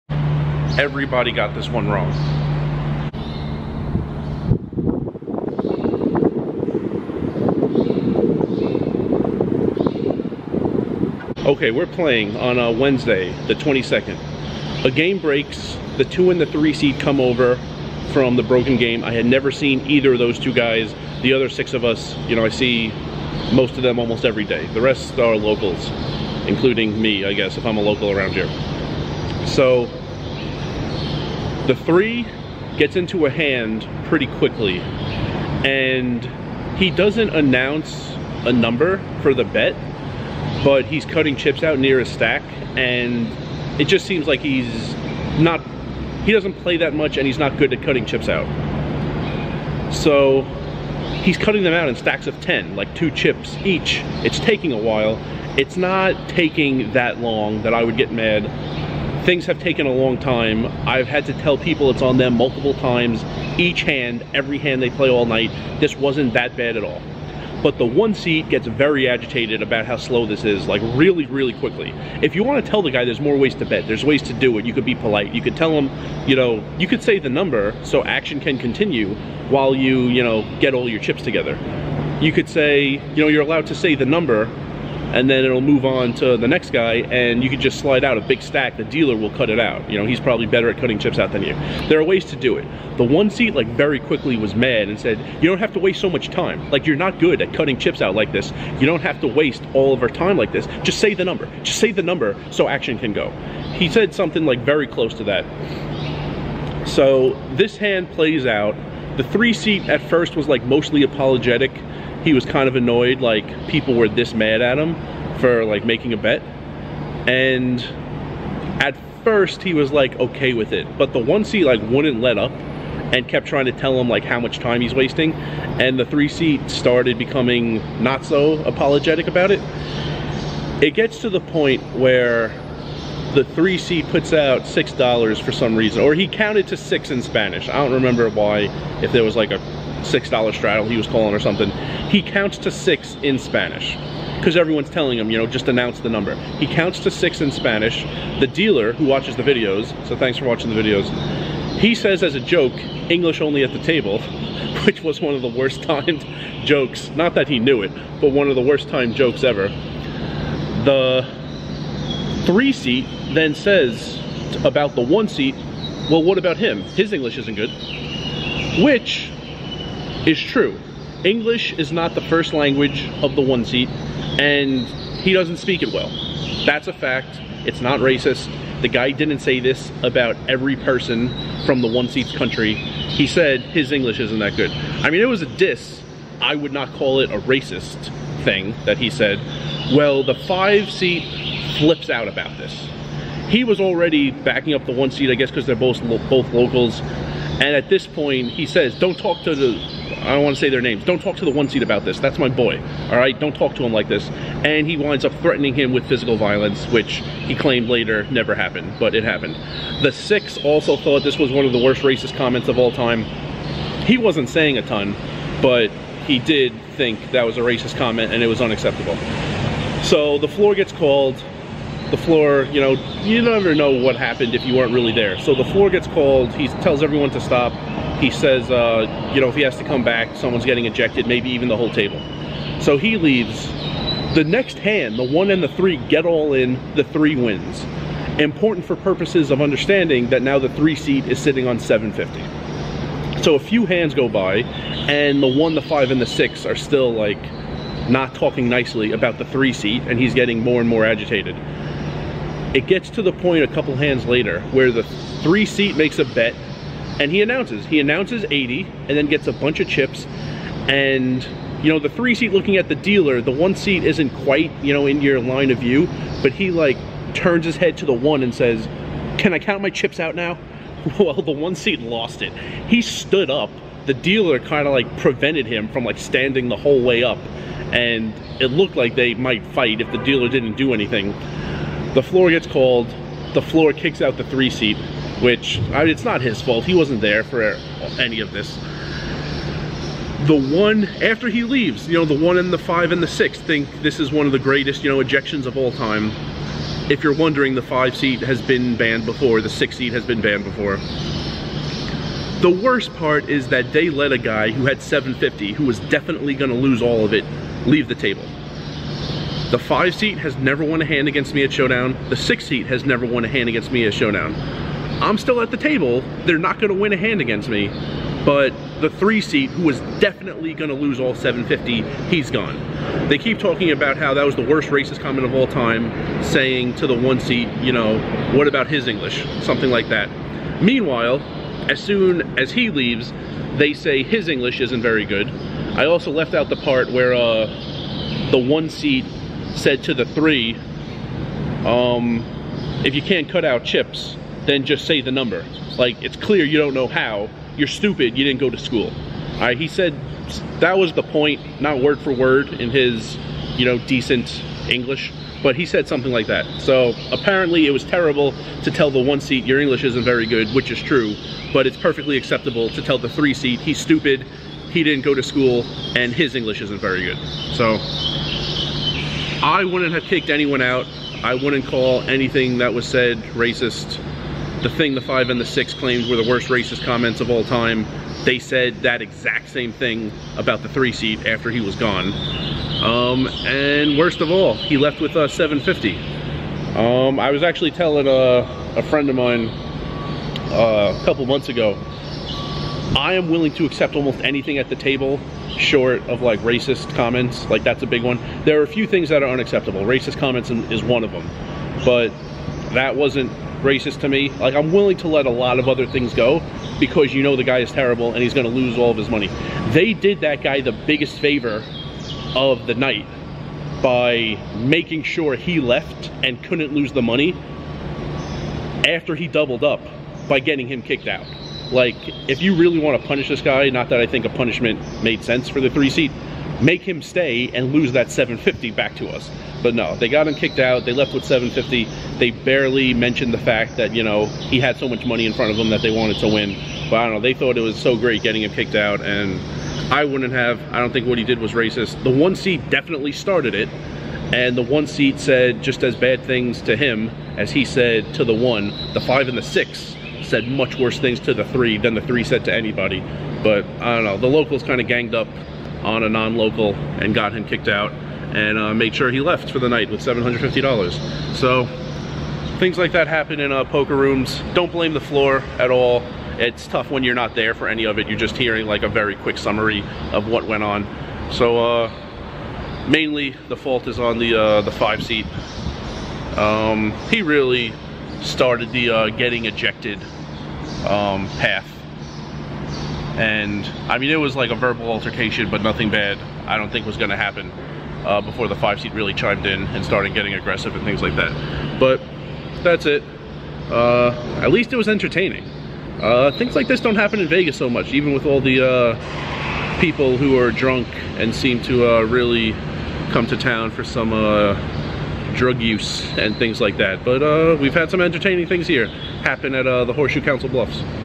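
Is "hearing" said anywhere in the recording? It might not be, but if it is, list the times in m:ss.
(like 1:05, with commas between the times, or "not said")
7:48.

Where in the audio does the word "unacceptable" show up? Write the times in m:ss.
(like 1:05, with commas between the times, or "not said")
3:38, 6:39.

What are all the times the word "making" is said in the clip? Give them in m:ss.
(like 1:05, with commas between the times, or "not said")
1:55, 6:54.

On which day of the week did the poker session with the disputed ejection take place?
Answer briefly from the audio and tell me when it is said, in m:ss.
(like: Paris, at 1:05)
Wednesday, at 0:12.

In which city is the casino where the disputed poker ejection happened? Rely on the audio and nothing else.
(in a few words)
Council Bluffs.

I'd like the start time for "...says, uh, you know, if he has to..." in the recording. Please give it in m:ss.
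3:48.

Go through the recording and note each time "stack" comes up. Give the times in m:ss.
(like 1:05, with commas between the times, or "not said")
0:42, 0:51, 1:28.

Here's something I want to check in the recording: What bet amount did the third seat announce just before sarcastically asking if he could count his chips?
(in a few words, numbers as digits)
80.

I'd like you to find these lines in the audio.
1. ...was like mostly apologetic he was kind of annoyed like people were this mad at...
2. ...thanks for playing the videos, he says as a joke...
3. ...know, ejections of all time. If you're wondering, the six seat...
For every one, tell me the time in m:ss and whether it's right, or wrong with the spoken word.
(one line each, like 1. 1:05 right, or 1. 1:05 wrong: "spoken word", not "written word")
1. 1:50 right
2. 2:30 wrong: "watching", not "playing"
3. 4:55 wrong: "five", not "six".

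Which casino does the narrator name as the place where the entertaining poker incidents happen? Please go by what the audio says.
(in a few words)
Horseshoe.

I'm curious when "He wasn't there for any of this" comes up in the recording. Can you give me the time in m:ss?
4:46.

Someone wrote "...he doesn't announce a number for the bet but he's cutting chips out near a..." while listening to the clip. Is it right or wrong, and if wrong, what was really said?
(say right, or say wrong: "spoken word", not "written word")
right.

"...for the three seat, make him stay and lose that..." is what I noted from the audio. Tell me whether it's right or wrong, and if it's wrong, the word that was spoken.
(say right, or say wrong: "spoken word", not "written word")
right.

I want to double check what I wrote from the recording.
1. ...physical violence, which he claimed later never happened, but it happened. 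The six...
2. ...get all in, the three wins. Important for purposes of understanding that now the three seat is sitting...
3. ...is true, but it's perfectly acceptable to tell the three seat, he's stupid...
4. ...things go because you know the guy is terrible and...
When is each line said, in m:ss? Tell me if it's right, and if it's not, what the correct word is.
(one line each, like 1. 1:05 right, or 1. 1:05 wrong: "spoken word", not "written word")
1. 3:26 right
2. 3:56 right
3. 6:00 right
4. 6:46 right.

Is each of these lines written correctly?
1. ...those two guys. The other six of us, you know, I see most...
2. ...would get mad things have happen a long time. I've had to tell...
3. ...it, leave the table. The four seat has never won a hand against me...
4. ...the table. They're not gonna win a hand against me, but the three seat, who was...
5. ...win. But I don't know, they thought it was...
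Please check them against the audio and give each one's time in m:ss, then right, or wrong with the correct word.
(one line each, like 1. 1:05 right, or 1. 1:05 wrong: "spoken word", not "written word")
1. 0:20 right
2. 0:57 wrong: "taken", not "happen"
3. 5:07 wrong: "five", not "four"
4. 5:15 right
5. 7:16 right.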